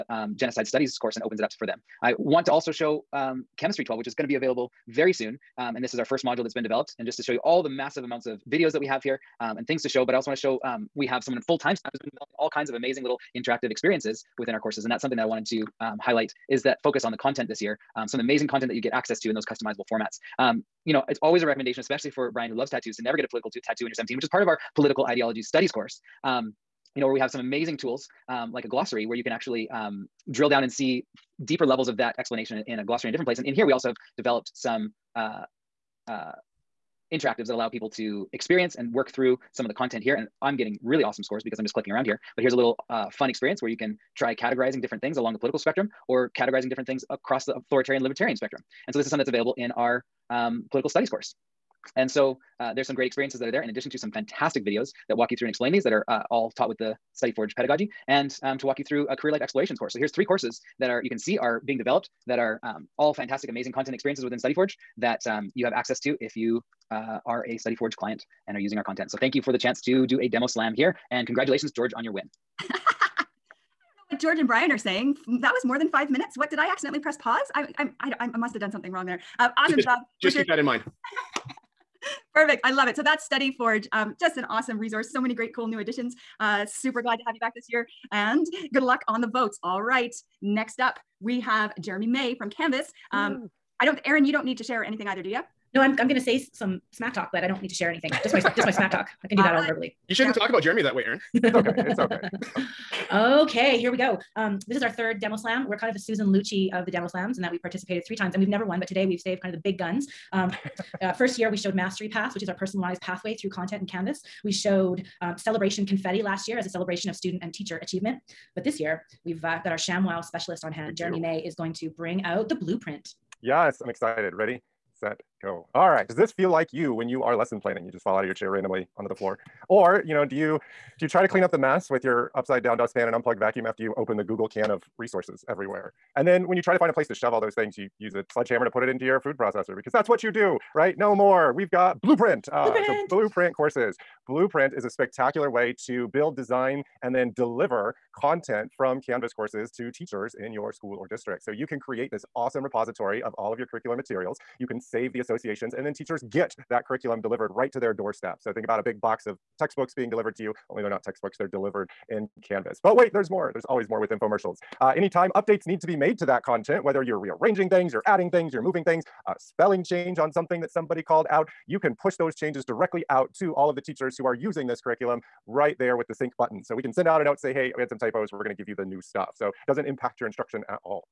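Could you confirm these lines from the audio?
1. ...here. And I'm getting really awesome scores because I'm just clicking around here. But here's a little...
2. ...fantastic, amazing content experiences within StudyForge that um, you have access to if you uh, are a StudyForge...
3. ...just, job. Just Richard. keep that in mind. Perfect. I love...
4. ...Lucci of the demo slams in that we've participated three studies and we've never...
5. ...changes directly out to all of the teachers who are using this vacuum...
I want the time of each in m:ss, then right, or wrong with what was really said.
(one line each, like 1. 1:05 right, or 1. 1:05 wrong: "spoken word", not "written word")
1. 0:40 right
2. 1:03 right
3. 1:19 right
4. 1:46 wrong: "times", not "studies"
5. 2:52 wrong: "curriculum", not "vacuum".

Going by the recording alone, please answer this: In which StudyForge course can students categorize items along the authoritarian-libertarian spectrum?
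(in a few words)
political studies.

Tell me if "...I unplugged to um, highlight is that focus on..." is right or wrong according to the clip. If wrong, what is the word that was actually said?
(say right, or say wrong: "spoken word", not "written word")
wrong: "wanted", not "unplugged".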